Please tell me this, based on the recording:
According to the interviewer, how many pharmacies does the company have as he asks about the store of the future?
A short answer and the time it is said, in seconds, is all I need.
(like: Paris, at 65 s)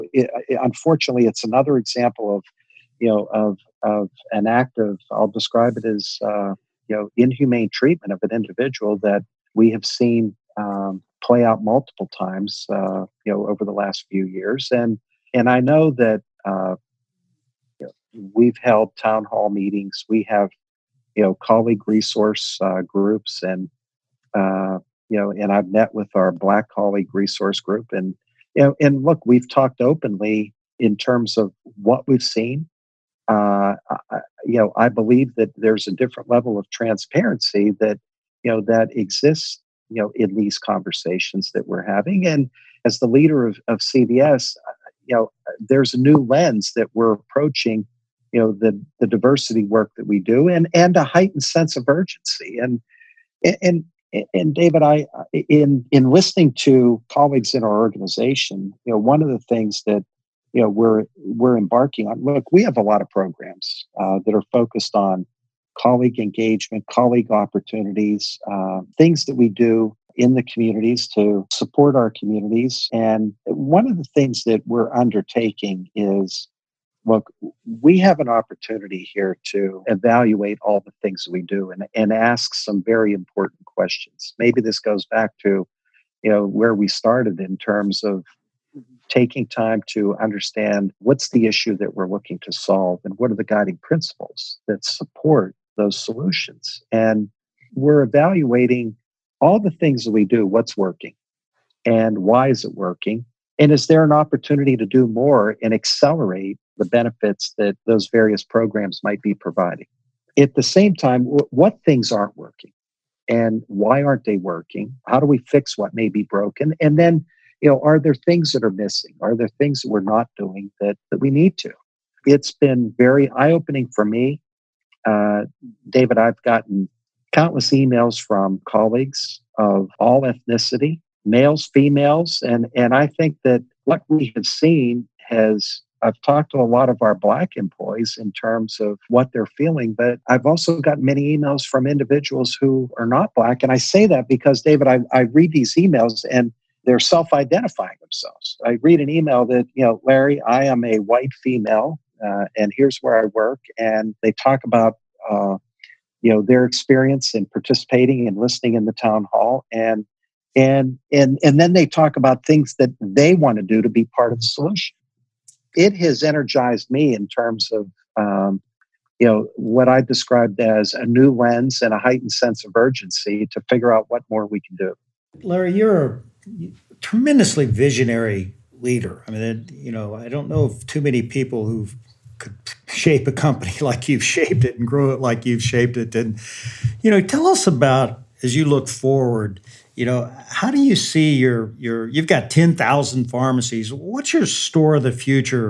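10,000, at 192 s.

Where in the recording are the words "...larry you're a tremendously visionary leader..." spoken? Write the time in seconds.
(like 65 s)
175 s.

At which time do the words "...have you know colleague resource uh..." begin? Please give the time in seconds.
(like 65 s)
20 s.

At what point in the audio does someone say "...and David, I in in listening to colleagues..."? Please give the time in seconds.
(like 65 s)
54 s.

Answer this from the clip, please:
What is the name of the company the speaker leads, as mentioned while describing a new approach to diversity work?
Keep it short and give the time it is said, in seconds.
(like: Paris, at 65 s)
CVS, at 43 s.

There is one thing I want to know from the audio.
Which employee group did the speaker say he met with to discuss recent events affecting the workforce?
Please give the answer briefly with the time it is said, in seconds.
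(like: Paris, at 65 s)
Black colleague resource group, at 26 s.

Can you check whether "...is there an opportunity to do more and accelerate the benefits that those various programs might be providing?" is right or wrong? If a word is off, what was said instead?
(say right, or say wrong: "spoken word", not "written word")
right.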